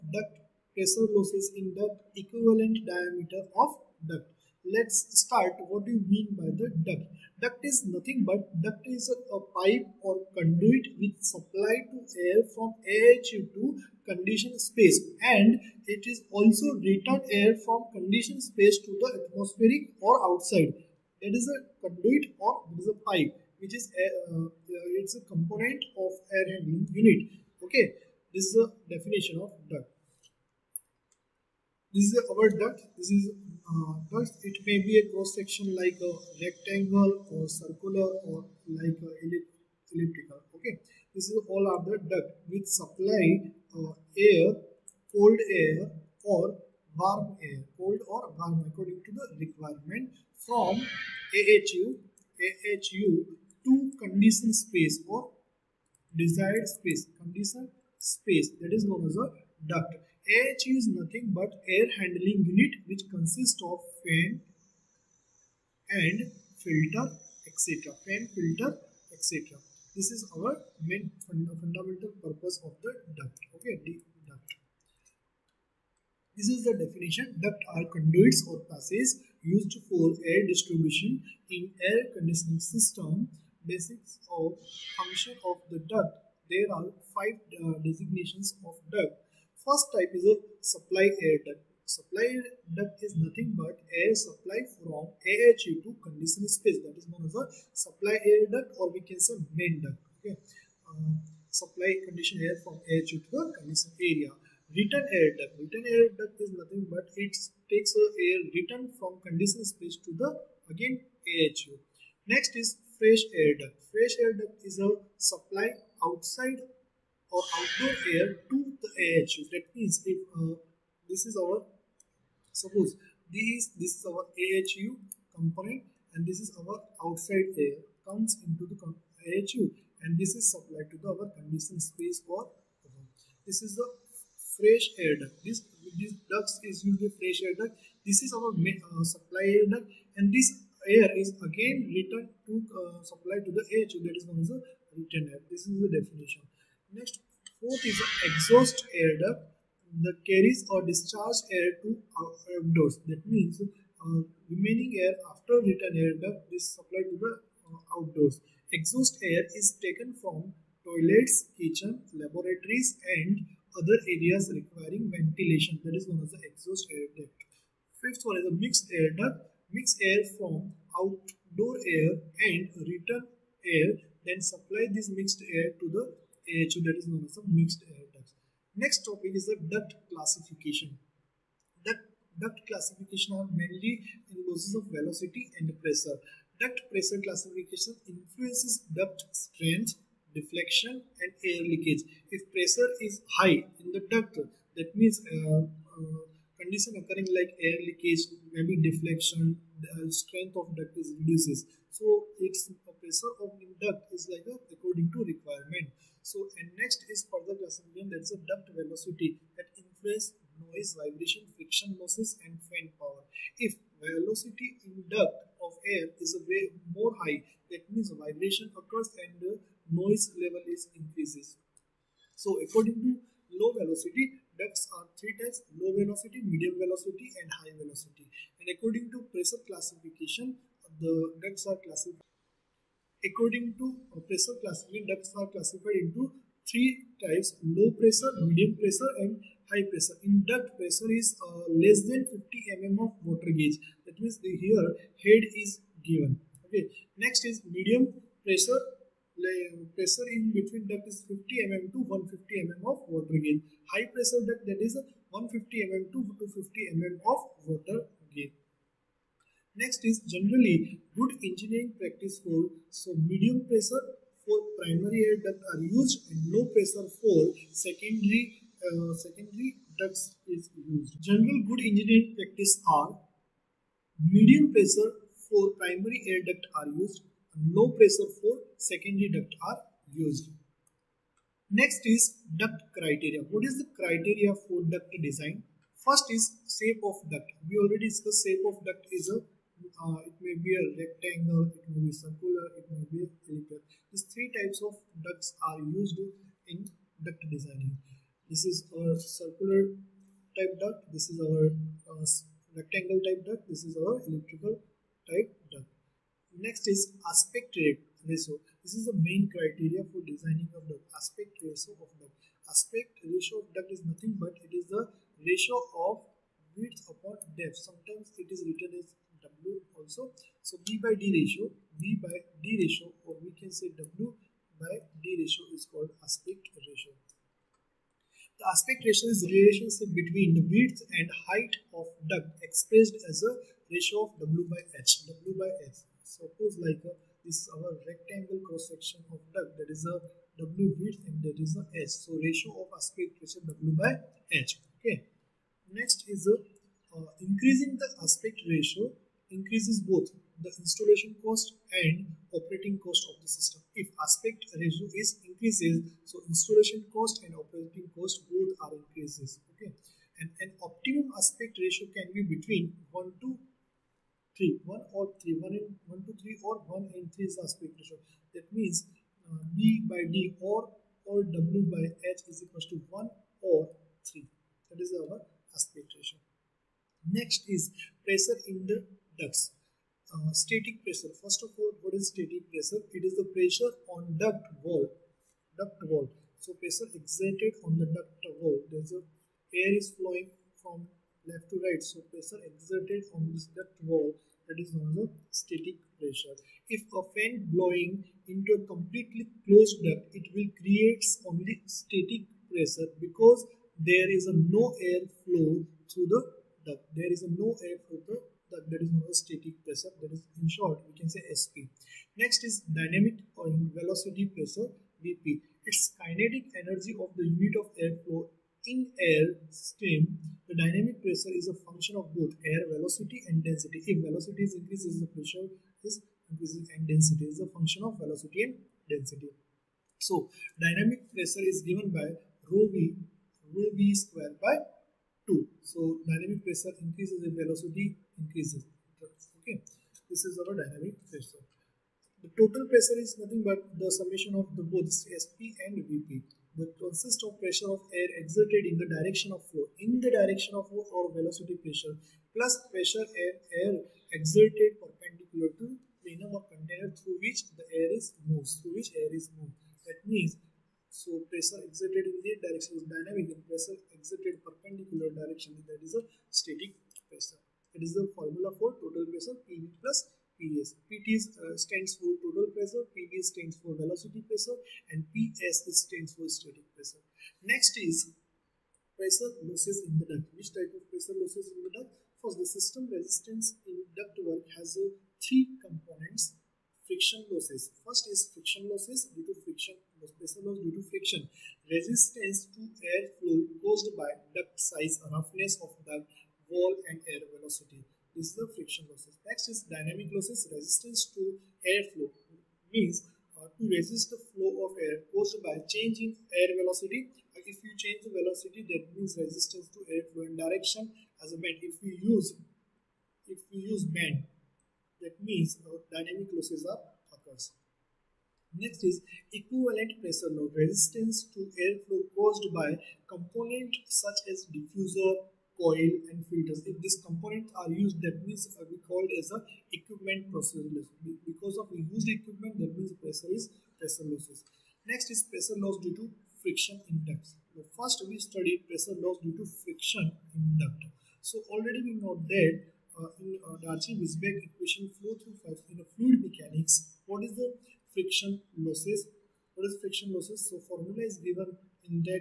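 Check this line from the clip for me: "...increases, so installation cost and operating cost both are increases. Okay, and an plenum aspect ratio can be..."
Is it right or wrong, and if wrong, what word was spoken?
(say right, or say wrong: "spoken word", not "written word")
wrong: "optimum", not "plenum".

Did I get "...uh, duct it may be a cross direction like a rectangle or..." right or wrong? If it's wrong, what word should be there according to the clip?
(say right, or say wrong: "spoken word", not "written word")
wrong: "section", not "direction".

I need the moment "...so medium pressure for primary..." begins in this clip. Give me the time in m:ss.
4:22.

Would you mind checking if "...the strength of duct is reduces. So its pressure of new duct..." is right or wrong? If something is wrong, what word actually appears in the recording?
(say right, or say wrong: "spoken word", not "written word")
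right.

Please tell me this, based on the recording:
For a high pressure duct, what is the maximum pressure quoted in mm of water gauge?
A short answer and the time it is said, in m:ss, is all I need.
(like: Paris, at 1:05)
250 mm, at 4:16.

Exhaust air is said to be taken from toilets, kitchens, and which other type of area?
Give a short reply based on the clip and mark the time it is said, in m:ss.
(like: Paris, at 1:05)
Laboratories, at 2:42.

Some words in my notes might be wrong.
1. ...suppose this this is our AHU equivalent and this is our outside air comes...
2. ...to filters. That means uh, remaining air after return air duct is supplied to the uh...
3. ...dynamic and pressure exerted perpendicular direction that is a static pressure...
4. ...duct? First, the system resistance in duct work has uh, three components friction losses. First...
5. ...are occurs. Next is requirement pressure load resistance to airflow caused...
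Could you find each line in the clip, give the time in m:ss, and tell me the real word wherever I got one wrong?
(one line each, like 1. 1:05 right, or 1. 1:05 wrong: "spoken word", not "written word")
1. 2:02 wrong: "component", not "equivalent"
2. 2:31 wrong: "outdoors", not "filters"
3. 7:43 right
4. 8:01 right
5. 8:36 wrong: "equivalent", not "requirement".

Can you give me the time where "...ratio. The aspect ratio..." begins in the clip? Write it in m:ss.
5:26.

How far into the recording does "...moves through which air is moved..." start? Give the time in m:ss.
7:38.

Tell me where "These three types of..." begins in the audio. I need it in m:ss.
4:54.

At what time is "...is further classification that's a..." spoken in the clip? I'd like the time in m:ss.
3:27.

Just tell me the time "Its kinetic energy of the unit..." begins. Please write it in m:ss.
6:55.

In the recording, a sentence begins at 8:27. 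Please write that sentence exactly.
Like if you change the velocity, that means resistance to airflow and direction as a bend.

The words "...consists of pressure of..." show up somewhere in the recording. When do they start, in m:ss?
7:26.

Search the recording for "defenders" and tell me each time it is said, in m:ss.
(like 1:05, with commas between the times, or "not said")
not said.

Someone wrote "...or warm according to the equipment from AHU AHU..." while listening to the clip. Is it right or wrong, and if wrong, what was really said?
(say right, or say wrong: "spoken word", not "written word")
wrong: "requirement", not "equipment".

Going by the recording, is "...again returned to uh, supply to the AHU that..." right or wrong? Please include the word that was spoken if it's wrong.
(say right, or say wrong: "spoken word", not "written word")
right.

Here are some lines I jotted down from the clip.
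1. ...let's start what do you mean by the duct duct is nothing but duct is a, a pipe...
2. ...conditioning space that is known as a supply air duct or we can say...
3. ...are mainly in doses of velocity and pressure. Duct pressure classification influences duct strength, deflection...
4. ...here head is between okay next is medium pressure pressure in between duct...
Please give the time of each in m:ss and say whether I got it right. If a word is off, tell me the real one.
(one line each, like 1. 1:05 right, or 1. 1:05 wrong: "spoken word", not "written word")
1. 0:04 right
2. 1:36 right
3. 3:03 right
4. 4:04 wrong: "given", not "between".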